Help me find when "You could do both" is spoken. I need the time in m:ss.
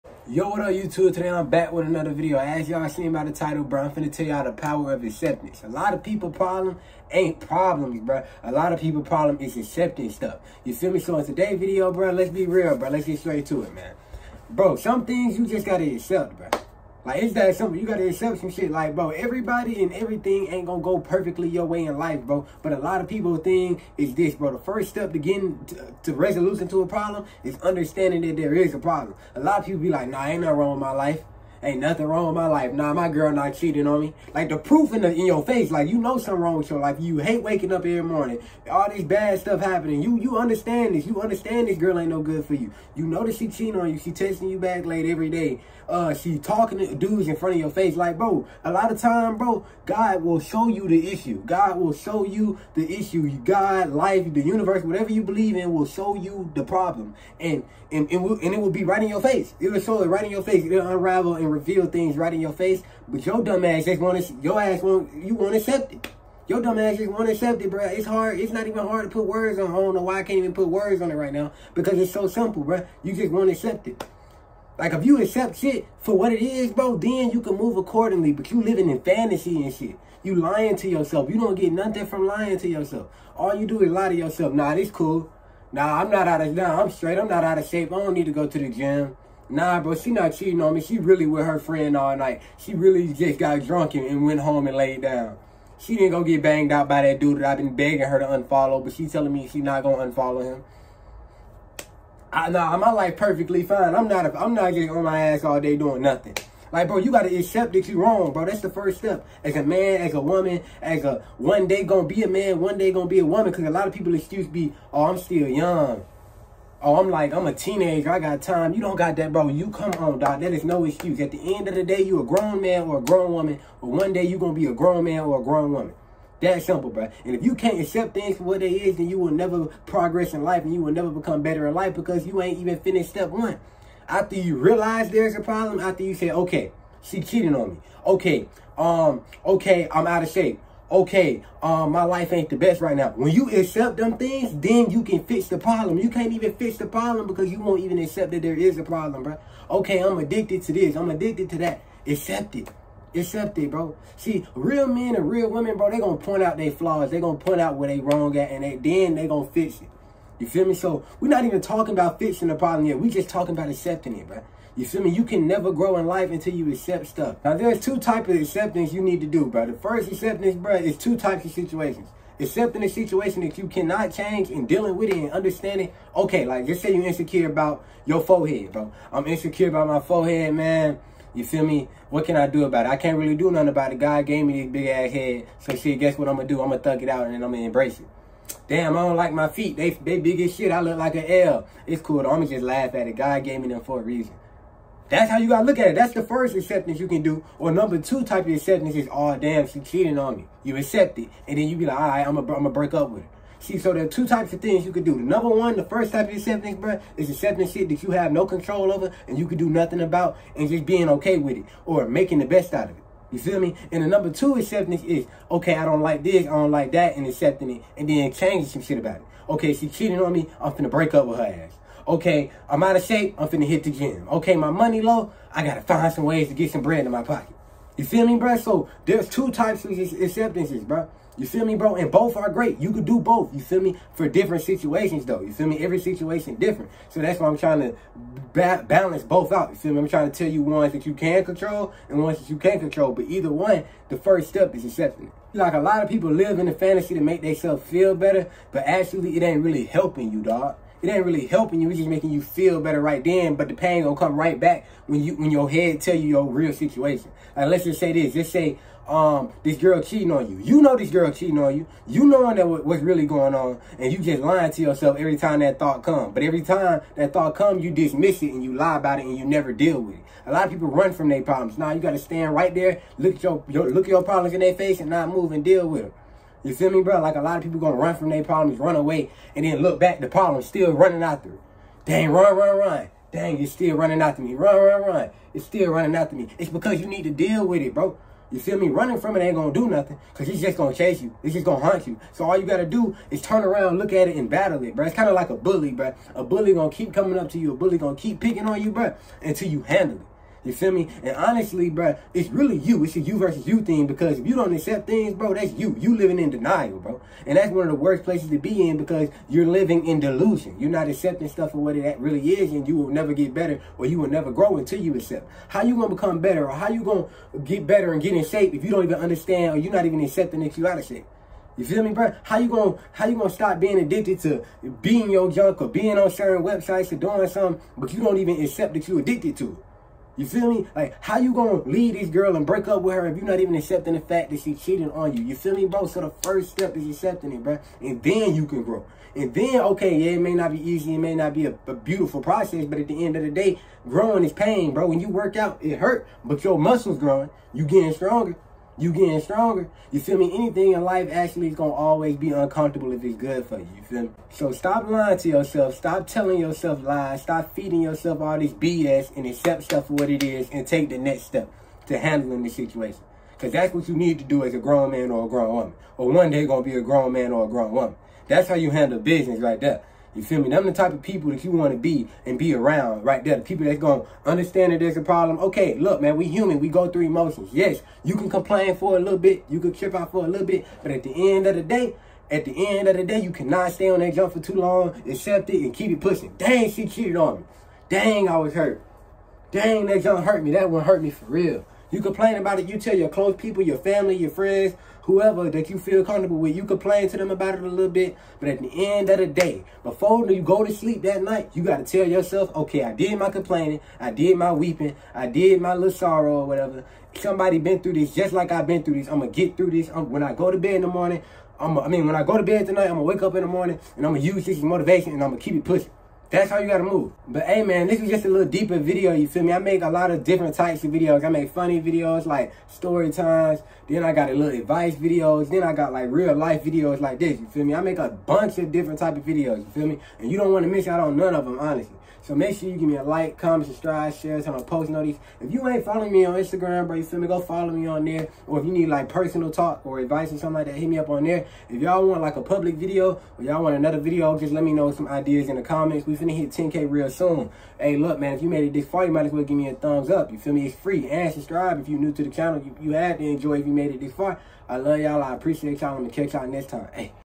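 3:52.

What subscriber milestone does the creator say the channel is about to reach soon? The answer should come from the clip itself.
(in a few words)
10K.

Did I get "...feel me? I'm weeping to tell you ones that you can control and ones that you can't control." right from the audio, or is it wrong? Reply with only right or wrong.
wrong.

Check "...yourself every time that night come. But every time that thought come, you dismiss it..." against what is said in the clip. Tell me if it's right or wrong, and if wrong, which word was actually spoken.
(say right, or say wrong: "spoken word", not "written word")
wrong: "thought", not "night".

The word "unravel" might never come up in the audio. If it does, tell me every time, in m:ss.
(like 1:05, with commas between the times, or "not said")
1:00.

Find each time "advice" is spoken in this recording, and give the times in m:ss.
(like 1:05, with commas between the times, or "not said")
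7:04, 7:20.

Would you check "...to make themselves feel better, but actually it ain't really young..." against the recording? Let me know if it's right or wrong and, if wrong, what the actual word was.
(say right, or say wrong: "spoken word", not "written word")
wrong: "helping", not "young".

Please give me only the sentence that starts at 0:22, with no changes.
But a lot of people think is this, bro.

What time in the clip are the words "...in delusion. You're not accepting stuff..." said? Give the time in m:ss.
5:10.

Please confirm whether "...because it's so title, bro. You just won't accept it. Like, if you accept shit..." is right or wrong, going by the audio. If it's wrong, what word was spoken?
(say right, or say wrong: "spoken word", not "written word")
wrong: "simple", not "title".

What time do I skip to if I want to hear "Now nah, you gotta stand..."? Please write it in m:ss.
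4:31.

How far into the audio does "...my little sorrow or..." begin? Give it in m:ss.
6:45.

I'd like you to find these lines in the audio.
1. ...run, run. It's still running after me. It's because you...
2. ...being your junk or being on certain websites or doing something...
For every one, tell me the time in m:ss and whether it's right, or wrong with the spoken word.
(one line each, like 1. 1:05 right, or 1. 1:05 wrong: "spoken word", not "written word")
1. 4:44 right
2. 5:25 right.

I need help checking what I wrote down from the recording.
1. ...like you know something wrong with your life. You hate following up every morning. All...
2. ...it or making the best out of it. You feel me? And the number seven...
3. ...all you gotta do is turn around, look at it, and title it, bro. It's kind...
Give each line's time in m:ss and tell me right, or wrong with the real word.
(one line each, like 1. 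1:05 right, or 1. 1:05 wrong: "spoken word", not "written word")
1. 0:35 wrong: "waking", not "following"
2. 3:31 wrong: "two", not "seven"
3. 4:52 wrong: "battle", not "title".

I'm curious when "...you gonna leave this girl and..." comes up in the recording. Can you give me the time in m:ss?
5:31.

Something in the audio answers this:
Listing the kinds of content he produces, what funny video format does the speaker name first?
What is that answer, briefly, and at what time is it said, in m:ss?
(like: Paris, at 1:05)
Story times, at 7:02.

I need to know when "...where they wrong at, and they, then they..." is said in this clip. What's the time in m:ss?
2:37.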